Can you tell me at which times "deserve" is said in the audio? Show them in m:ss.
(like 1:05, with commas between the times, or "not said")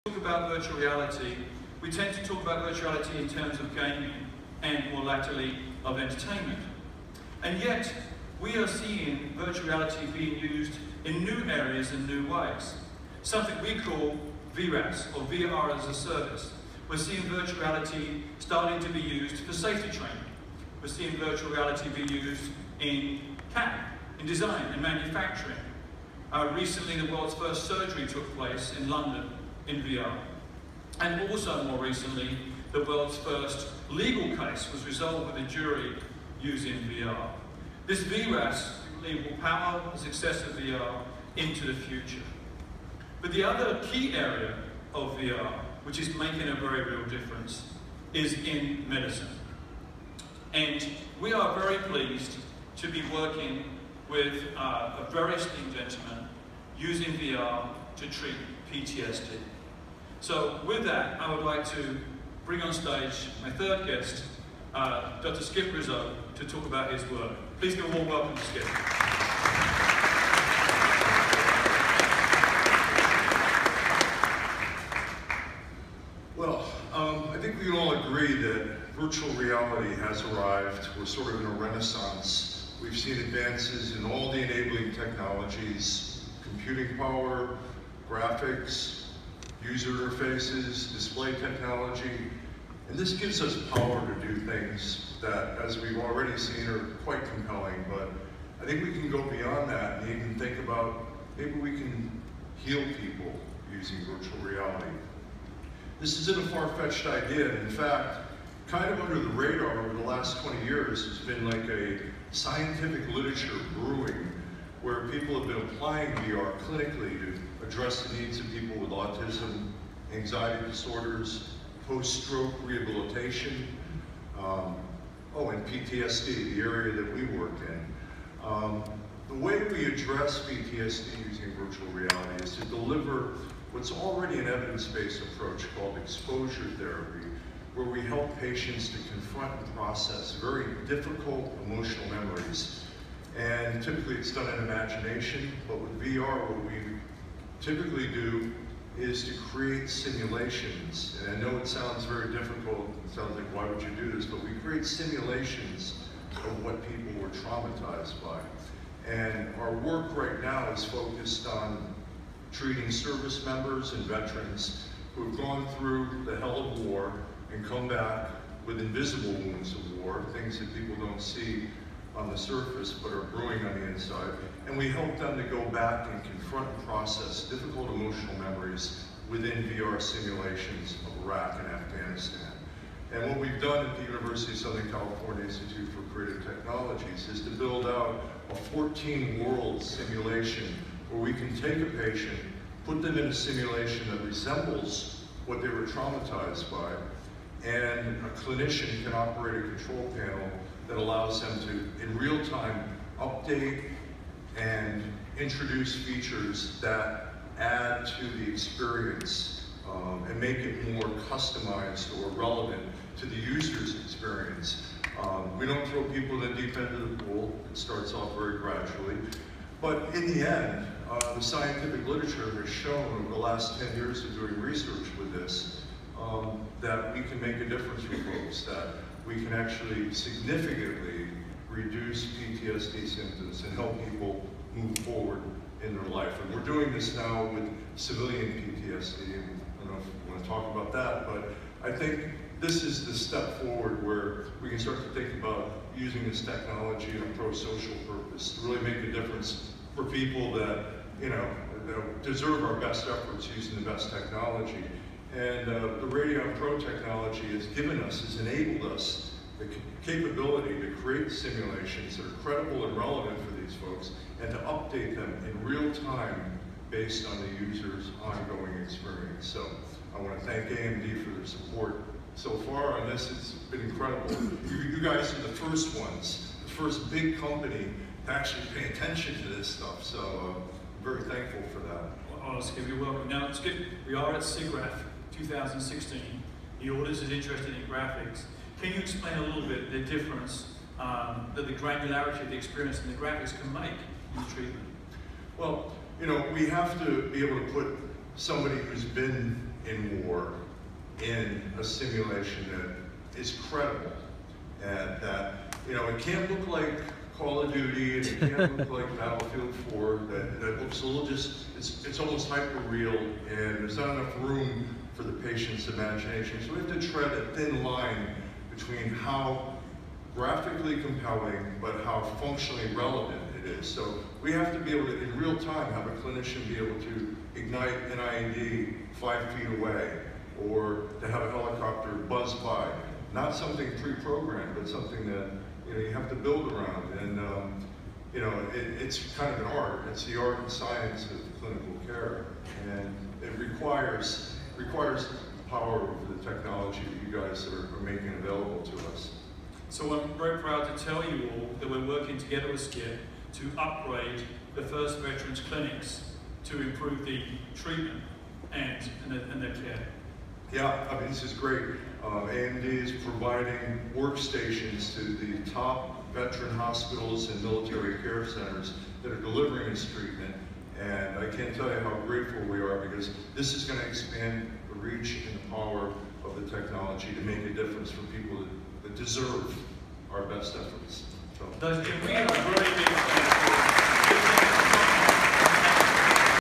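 4:12, 6:19.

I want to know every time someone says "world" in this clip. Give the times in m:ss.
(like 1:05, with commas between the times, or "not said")
0:27, 0:32, 3:08.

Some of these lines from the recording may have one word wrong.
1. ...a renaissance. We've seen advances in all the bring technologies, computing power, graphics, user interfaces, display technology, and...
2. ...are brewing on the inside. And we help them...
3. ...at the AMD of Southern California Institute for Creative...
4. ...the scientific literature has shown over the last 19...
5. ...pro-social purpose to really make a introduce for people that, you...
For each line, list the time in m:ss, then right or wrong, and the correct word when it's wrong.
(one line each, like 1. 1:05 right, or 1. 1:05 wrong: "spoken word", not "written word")
1. 1:21 wrong: "enabling", not "bring"
2. 2:53 right
3. 3:03 wrong: "University", not "AMD"
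4. 3:41 wrong: "10", not "19"
5. 4:07 wrong: "difference", not "introduce".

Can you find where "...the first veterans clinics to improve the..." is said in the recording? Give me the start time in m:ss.
5:54.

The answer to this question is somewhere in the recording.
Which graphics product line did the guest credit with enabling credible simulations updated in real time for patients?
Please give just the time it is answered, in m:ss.
4:16.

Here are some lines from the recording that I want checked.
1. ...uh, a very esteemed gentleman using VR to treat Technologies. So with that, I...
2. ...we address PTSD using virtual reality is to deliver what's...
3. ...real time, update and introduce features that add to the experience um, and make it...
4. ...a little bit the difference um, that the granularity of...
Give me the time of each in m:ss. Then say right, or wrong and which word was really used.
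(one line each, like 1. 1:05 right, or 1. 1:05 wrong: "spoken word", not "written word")
1. 0:54 wrong: "PTSD", not "Technologies"
2. 2:09 right
3. 3:22 right
4. 4:49 right.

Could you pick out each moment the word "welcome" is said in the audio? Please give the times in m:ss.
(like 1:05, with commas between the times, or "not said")
1:08, 4:43.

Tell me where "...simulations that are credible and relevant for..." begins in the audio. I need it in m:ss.
4:21.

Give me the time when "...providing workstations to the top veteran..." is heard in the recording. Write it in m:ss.
6:03.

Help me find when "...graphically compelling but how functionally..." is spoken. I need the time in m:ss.
5:20.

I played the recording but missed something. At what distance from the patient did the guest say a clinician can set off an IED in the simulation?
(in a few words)
5 feet.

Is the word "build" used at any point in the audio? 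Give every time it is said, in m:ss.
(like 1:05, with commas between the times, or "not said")
3:07, 5:36.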